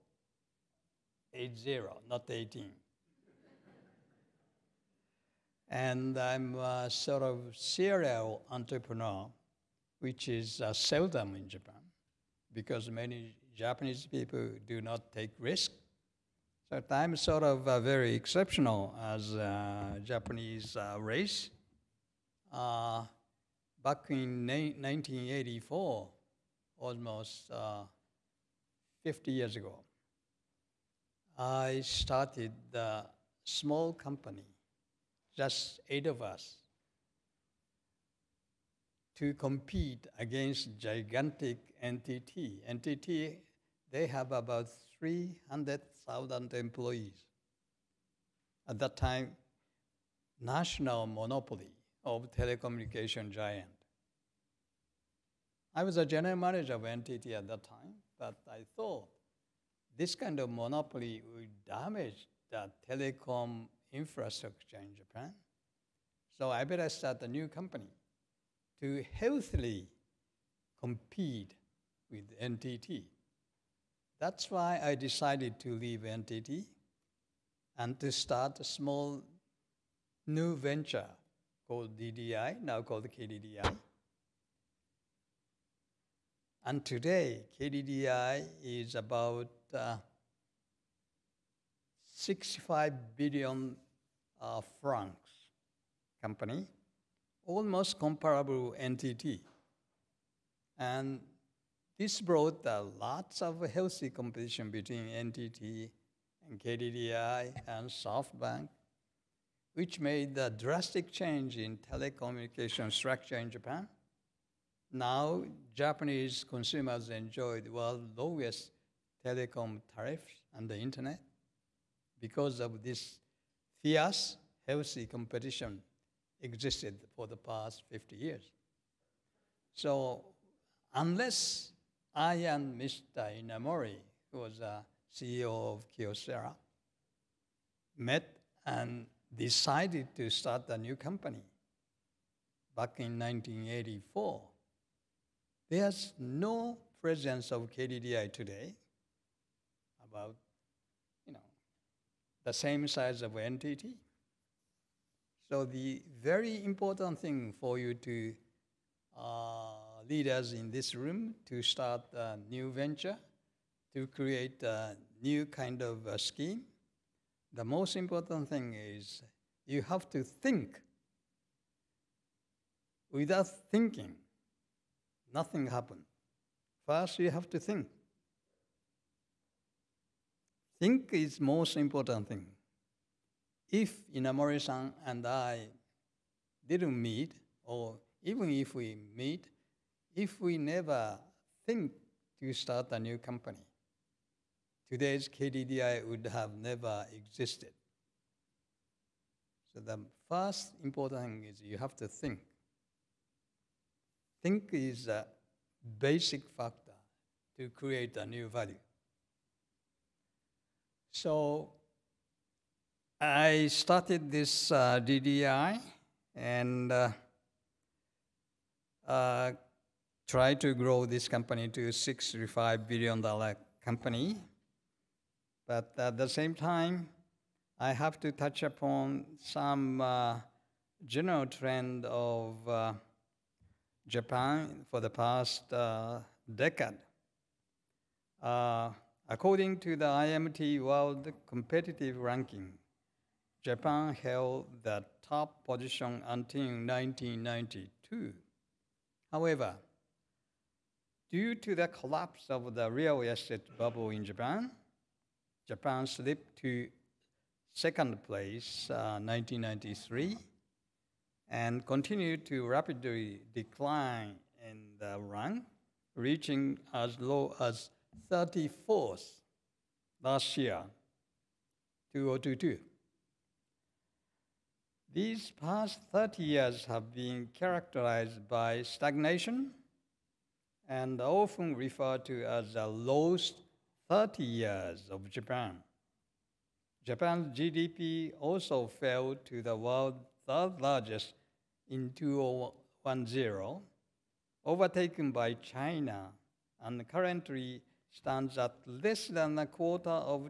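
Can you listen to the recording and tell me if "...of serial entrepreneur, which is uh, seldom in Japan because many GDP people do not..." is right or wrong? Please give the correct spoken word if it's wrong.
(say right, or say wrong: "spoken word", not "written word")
wrong: "Japanese", not "GDP".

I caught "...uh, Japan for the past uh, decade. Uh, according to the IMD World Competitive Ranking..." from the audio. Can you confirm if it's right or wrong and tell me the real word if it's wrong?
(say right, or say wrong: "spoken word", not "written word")
right.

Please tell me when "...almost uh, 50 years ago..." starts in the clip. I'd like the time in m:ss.
0:26.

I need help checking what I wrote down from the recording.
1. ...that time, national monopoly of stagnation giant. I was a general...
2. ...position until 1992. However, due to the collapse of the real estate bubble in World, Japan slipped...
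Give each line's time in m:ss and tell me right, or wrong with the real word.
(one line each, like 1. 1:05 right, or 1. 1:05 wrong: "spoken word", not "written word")
1. 0:48 wrong: "telecommunication", not "stagnation"
2. 4:05 wrong: "Japan", not "World".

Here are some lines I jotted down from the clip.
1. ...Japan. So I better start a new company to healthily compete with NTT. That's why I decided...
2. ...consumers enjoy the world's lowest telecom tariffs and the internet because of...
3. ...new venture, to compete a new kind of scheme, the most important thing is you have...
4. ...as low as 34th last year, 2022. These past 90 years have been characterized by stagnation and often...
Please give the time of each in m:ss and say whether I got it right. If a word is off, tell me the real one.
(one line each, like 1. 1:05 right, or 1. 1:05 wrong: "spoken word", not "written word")
1. 1:04 right
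2. 1:56 right
3. 2:42 wrong: "create", not "compete"
4. 4:26 wrong: "30", not "90".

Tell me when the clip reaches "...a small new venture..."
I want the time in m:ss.
1:18.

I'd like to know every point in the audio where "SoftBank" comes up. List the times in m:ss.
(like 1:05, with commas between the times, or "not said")
1:47.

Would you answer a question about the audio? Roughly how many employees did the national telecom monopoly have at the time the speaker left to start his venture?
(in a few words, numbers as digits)
300,000.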